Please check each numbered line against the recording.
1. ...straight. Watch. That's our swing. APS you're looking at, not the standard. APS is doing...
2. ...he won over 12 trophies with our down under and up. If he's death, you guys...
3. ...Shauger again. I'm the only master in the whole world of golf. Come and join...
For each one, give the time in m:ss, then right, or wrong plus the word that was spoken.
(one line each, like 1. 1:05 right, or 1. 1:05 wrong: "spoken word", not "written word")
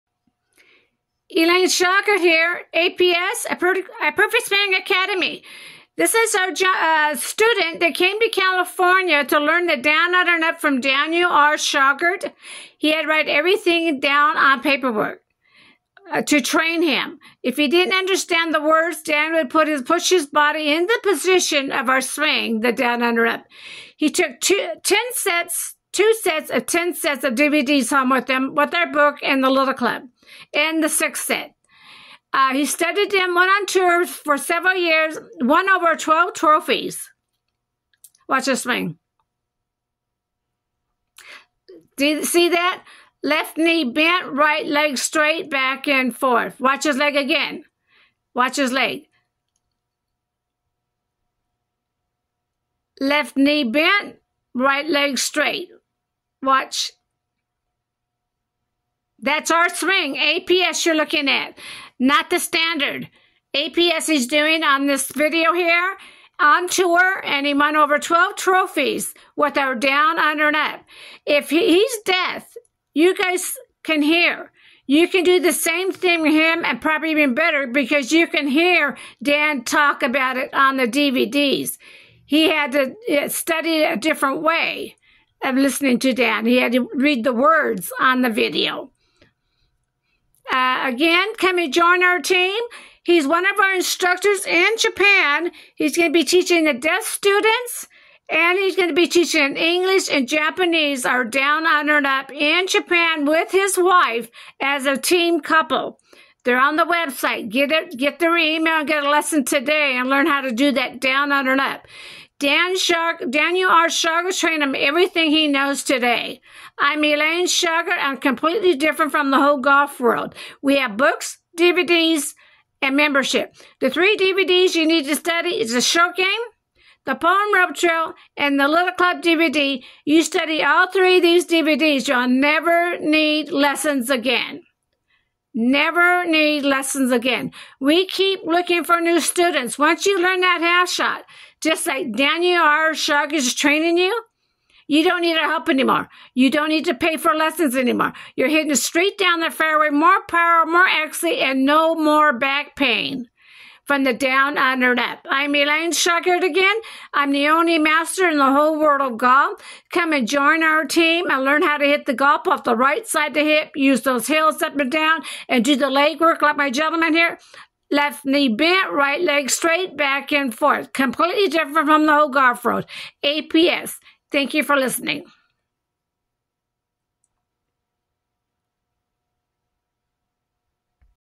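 1. 0:55 right
2. 1:07 right
3. 2:35 right.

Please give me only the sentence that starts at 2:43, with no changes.
Use those hills up and down and do the leg work like my gentleman here.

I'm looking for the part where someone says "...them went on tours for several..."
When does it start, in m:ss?
0:33.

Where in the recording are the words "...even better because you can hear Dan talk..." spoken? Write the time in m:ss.
1:17.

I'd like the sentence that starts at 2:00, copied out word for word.
We have books, DVDs, and membership.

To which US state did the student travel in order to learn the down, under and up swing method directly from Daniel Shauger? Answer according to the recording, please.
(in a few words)
California.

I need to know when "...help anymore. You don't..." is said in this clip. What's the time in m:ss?
2:25.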